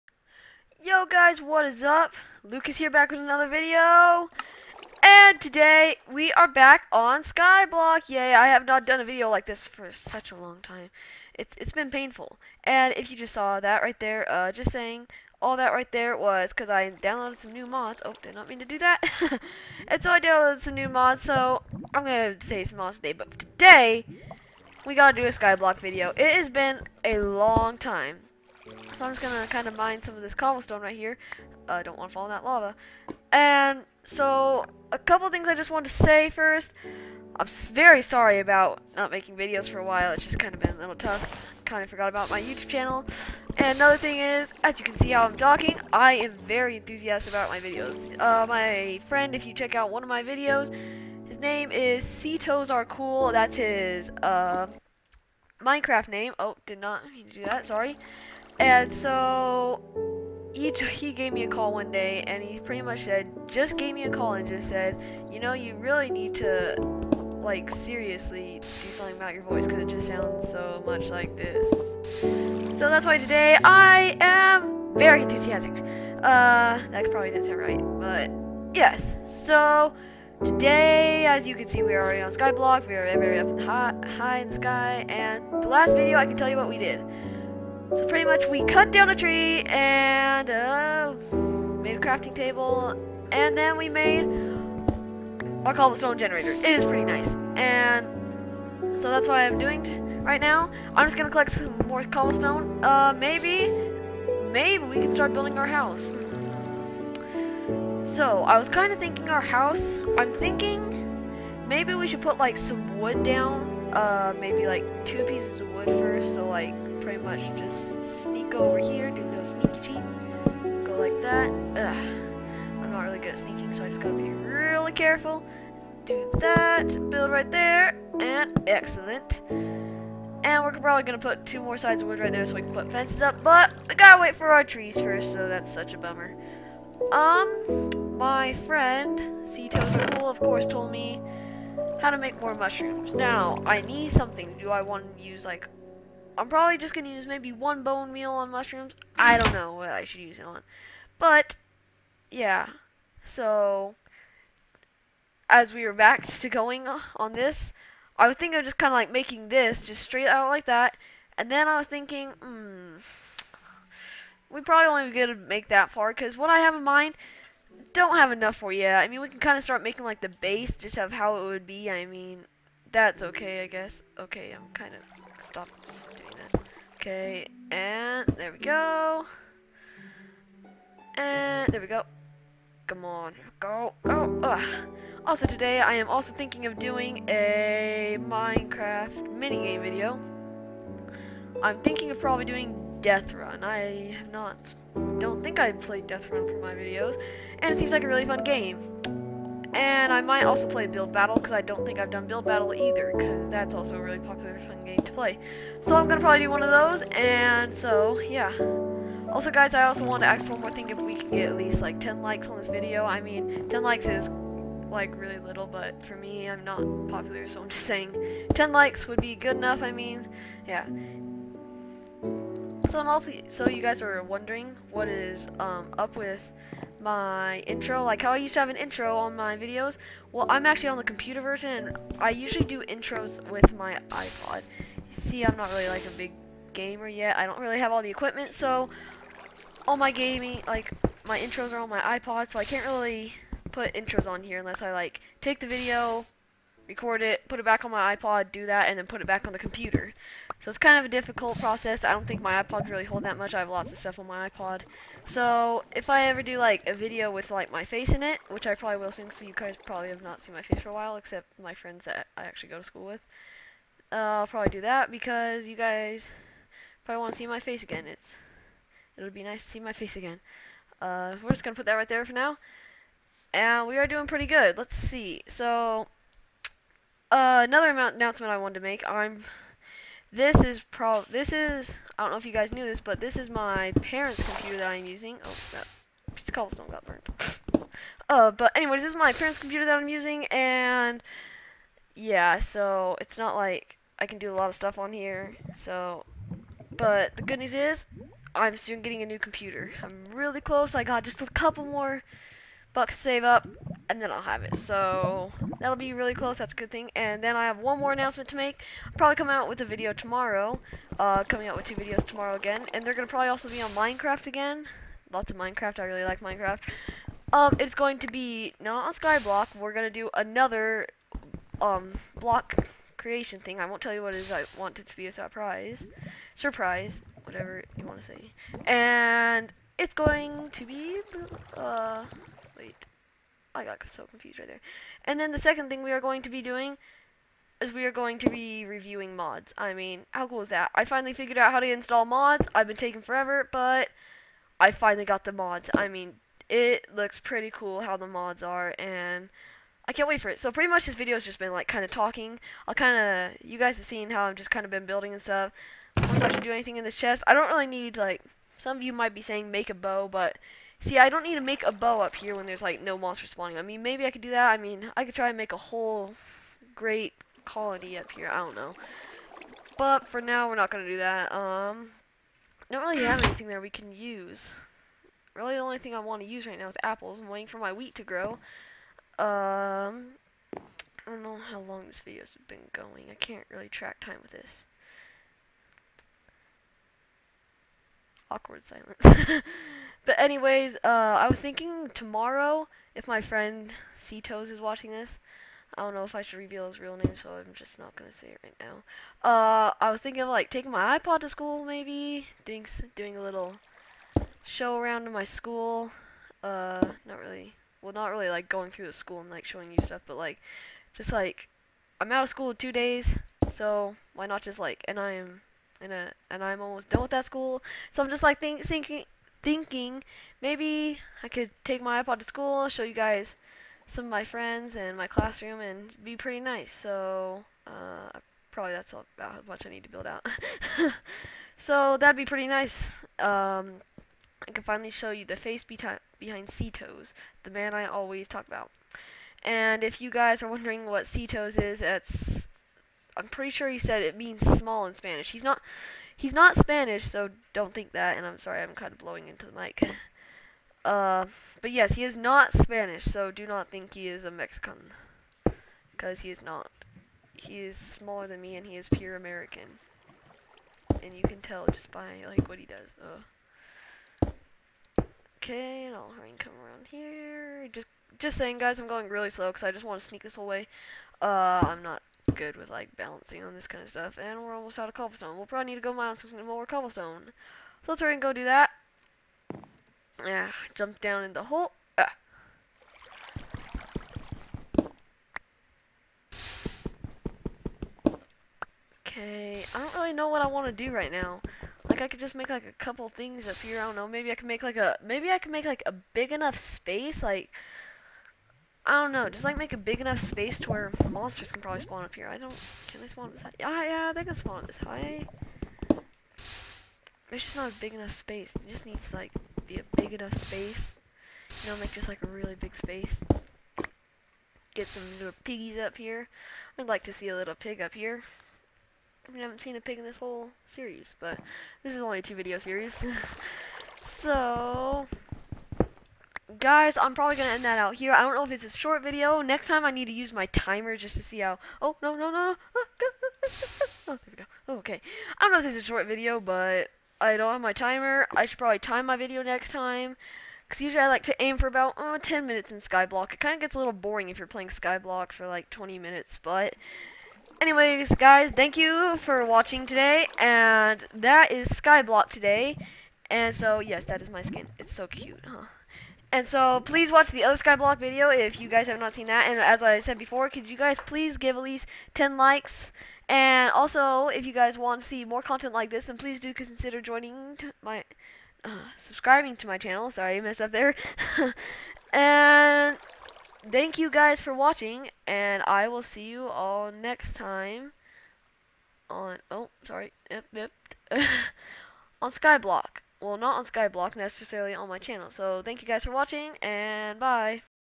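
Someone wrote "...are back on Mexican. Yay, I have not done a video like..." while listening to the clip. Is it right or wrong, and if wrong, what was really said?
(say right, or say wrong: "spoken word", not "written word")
wrong: "Skyblock", not "Mexican".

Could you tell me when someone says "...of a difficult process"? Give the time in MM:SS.
04:10.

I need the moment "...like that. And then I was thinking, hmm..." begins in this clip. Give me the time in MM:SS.
02:40.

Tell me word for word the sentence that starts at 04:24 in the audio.
Uh, I'll probably do that because you guys probably want to see my face again.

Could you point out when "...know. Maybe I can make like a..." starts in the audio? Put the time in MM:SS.
08:14.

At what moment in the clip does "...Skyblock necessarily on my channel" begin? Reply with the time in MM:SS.
09:43.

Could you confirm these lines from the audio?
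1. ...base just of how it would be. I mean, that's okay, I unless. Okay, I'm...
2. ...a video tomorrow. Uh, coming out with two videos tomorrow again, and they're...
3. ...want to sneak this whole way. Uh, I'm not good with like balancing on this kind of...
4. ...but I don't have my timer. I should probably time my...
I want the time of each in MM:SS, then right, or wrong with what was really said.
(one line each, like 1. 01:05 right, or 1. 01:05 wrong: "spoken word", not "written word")
1. 02:50 wrong: "guess", not "unless"
2. 05:09 right
3. 07:50 right
4. 08:56 right.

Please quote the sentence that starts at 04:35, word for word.
So uh, another announcement I wanted to make.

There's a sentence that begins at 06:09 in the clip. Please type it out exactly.
But for now, we're not going to do that.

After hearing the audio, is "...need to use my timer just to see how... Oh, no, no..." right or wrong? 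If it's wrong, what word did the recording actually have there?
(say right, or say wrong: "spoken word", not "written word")
right.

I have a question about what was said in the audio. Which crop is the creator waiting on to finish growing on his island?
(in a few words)
Wheat.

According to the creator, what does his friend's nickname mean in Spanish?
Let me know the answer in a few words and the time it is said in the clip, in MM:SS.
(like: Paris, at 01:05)
Small, at 07:24.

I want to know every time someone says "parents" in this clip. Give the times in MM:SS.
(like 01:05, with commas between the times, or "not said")
04:44, 04:49.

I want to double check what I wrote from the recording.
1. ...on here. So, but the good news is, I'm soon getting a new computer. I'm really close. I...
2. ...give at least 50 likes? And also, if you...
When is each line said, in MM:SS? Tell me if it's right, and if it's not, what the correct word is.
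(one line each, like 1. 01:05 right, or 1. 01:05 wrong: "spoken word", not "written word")
1. 04:54 right
2. 09:21 wrong: "10", not "50".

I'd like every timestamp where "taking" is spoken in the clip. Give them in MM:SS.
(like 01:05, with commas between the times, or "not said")
05:42, 06:40.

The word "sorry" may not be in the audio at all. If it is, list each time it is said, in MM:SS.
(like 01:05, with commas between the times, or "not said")
00:38, 00:57, 07:28, 09:30, 09:40.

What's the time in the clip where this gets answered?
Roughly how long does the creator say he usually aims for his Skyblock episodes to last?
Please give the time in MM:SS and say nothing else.
09:02.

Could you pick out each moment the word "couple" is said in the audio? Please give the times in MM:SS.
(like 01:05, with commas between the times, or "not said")
00:34, 05:01, 08:13.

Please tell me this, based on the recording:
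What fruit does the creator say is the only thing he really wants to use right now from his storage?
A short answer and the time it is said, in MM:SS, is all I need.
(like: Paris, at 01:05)
Apples, at 06:17.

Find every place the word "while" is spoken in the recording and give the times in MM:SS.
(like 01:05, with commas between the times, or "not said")
00:39, 04:20.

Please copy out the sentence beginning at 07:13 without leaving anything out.
Um, I can finally show you the face behind Cetos, the man I always talk about.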